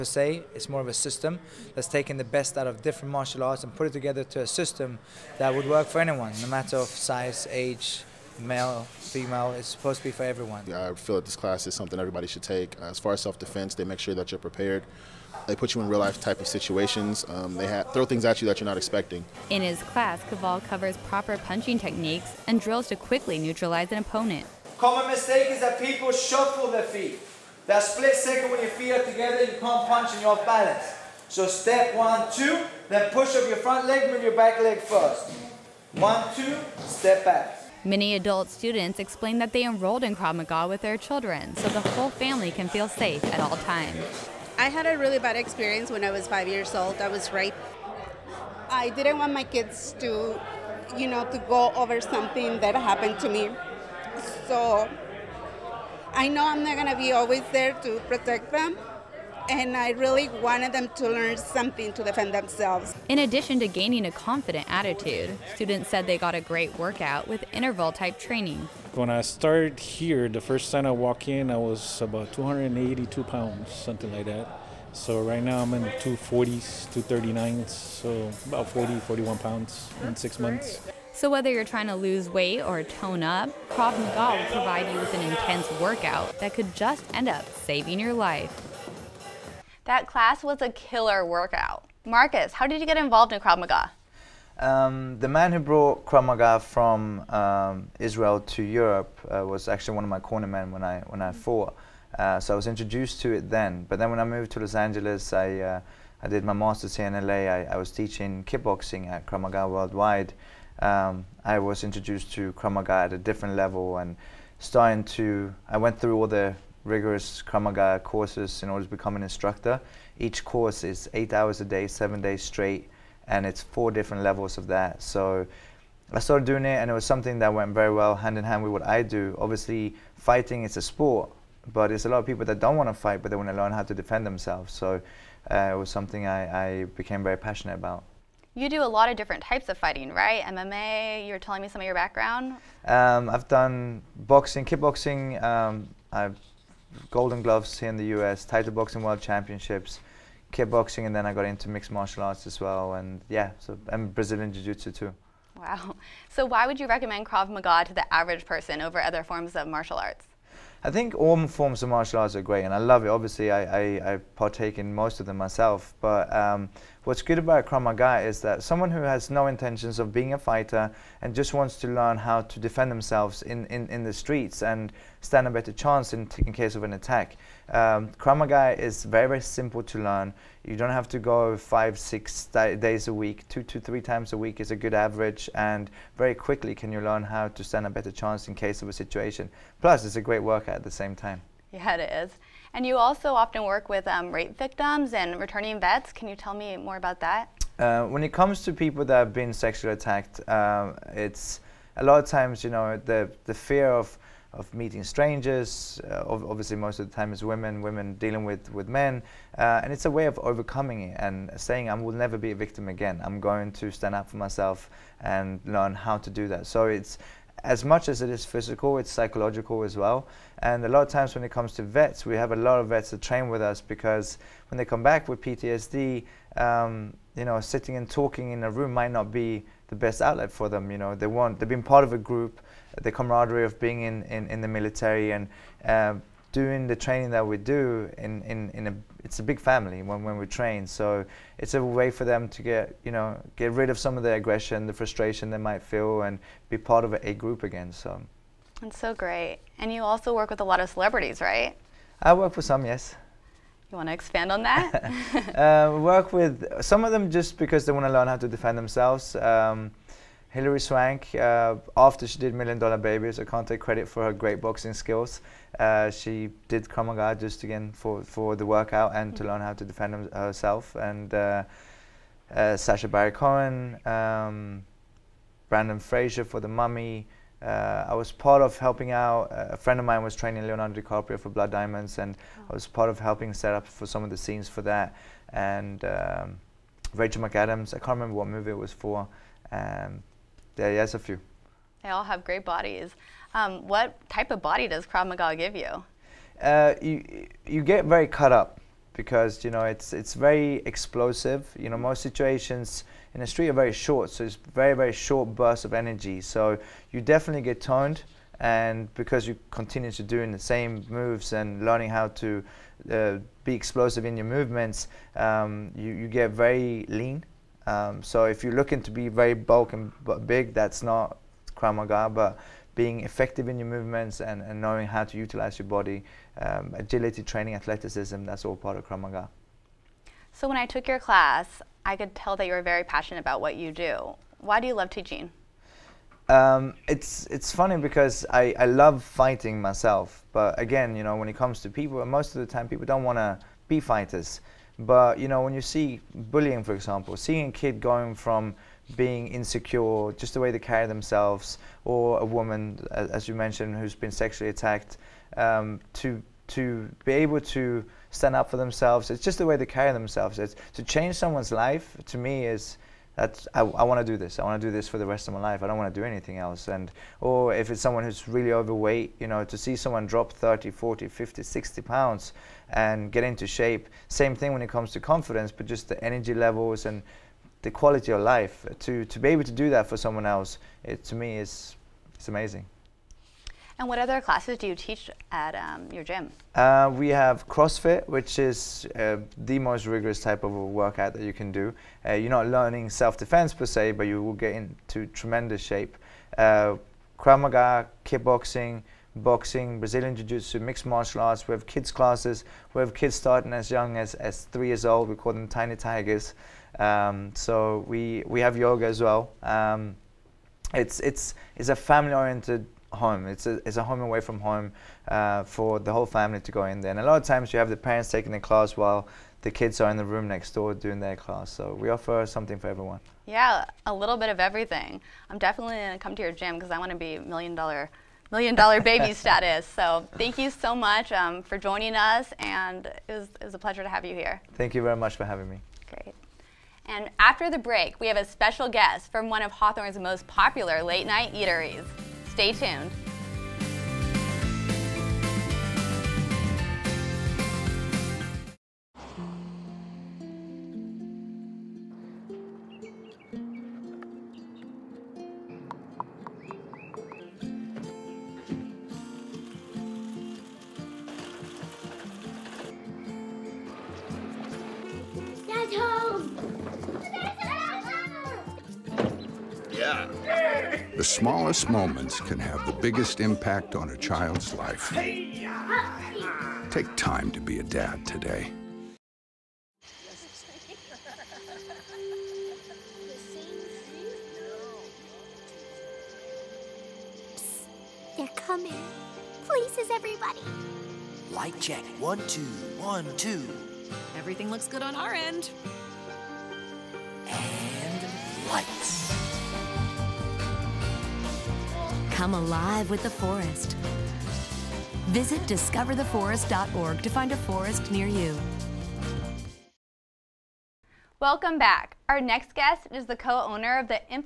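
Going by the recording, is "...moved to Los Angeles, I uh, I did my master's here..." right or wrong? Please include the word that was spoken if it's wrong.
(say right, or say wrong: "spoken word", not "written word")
right.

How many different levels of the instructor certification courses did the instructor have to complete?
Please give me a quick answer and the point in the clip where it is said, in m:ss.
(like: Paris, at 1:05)
4, at 2:03.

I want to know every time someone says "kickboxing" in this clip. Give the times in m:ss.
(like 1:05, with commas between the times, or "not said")
1:48, 2:24, 2:30, 6:38.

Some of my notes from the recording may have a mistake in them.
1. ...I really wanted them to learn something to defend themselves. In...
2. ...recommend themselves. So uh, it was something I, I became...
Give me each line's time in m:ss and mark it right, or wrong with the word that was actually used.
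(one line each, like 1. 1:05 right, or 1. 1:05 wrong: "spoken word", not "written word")
1. 0:59 right
2. 2:13 wrong: "defend", not "recommend".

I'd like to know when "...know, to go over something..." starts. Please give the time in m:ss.
0:51.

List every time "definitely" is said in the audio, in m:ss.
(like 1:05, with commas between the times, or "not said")
5:07, 7:05.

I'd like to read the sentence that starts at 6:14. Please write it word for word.
Same thing when it comes to confidence, but just the energy levels and the quality of life.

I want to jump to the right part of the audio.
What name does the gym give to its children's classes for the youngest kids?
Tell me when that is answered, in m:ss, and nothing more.
6:45.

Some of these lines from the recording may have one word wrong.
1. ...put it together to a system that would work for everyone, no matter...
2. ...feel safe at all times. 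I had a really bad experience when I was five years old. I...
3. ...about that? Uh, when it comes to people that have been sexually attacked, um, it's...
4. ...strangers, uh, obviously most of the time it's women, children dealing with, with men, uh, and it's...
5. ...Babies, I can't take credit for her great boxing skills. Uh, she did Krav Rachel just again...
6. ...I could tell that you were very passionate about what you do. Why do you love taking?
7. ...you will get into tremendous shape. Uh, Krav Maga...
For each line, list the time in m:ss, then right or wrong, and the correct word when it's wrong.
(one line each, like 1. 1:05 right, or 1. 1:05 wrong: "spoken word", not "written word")
1. 0:03 wrong: "anyone", not "everyone"
2. 0:42 right
3. 3:16 right
4. 3:25 wrong: "women", not "children"
5. 4:22 wrong: "Maga", not "Rachel"
6. 5:32 wrong: "teaching", not "taking"
7. 6:34 right.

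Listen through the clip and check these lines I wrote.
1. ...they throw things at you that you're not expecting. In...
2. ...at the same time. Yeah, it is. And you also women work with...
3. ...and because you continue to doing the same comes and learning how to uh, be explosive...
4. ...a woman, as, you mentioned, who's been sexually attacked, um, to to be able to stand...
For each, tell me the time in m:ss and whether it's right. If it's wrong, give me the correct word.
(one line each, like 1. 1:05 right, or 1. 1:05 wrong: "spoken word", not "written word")
1. 0:17 right
2. 3:10 wrong: "often", not "women"
3. 5:08 wrong: "moves", not "comes"
4. 5:52 right.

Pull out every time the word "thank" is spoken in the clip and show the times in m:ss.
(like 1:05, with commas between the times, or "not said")
7:10, 7:14.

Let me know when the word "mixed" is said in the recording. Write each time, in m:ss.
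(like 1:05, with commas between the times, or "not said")
2:31, 6:40.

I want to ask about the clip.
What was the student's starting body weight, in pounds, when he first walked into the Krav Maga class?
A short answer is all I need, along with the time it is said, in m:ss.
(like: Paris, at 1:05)
282, at 1:12.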